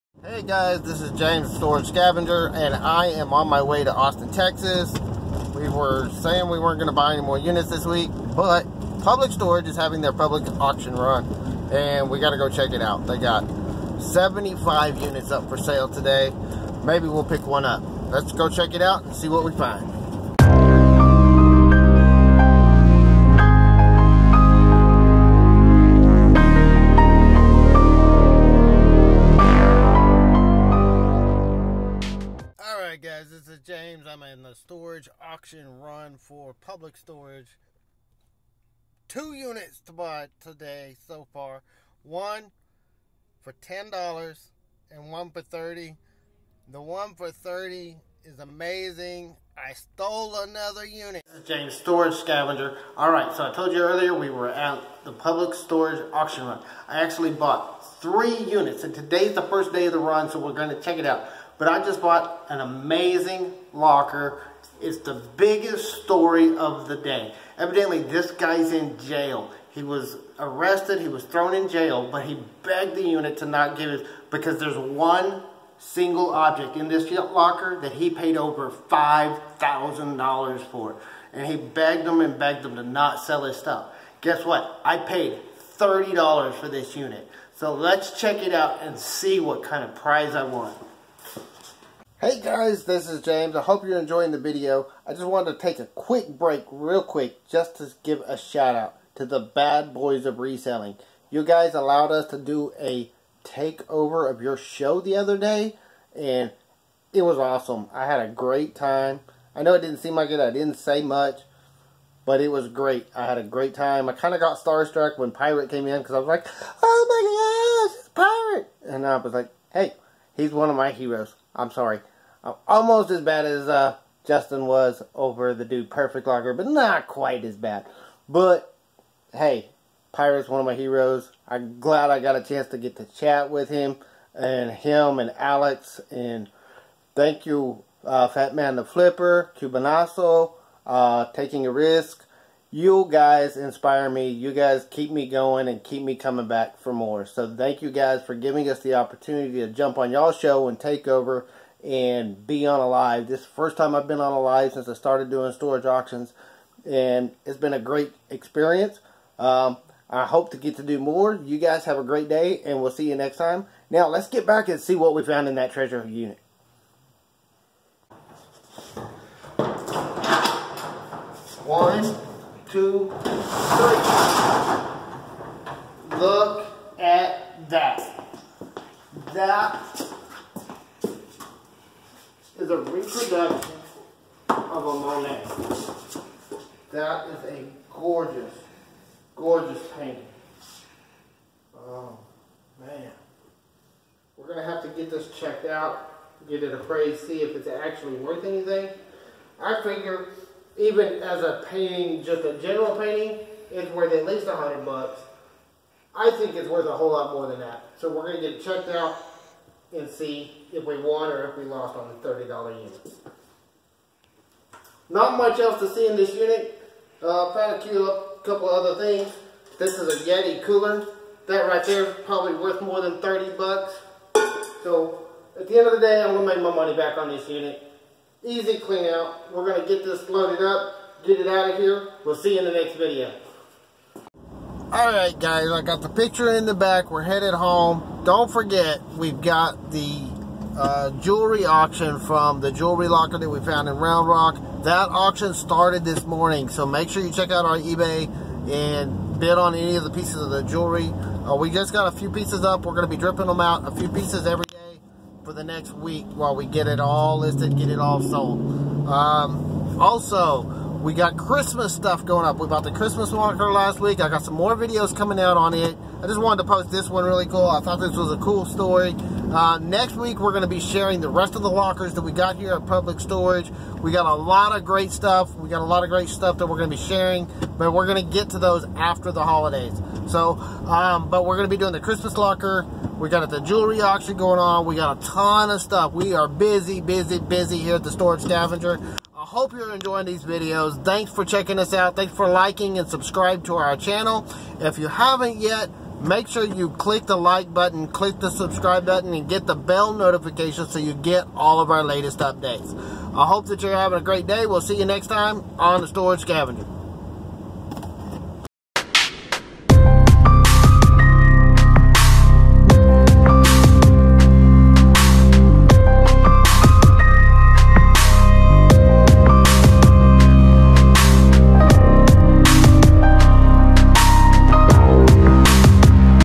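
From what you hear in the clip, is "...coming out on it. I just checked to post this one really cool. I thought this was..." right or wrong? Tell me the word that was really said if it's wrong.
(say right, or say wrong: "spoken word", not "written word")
wrong: "wanted", not "checked".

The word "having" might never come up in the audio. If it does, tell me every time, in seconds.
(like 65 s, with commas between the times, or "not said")
9 s, 303 s.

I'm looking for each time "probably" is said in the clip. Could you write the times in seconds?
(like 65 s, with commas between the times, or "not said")
222 s.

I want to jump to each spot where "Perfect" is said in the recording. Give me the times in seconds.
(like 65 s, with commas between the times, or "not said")
125 s.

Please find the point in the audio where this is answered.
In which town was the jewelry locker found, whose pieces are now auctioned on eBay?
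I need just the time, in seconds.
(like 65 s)
243 s.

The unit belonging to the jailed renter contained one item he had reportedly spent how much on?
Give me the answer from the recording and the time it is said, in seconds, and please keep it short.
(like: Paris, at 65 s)
over $5,000, at 78 s.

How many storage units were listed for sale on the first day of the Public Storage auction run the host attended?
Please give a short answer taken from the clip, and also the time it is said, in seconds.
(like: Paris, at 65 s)
75, at 14 s.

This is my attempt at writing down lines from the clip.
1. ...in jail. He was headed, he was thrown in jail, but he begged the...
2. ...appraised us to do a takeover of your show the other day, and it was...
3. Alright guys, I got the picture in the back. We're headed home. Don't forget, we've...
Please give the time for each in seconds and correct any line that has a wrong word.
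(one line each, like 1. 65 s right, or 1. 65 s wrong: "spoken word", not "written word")
1. 68 s wrong: "arrested", not "headed"
2. 101 s wrong: "allowed", not "appraised"
3. 234 s right.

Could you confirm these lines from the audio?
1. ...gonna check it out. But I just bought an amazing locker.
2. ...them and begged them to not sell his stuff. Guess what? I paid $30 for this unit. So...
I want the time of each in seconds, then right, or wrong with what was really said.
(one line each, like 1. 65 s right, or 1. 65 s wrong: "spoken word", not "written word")
1. 60 s right
2. 82 s right.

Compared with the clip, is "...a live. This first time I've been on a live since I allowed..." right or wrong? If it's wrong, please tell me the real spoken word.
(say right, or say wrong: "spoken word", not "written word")
wrong: "started", not "allowed".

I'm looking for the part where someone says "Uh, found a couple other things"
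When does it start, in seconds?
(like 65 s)
217 s.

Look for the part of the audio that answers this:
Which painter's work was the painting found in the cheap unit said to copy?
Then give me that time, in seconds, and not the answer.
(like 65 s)
184 s.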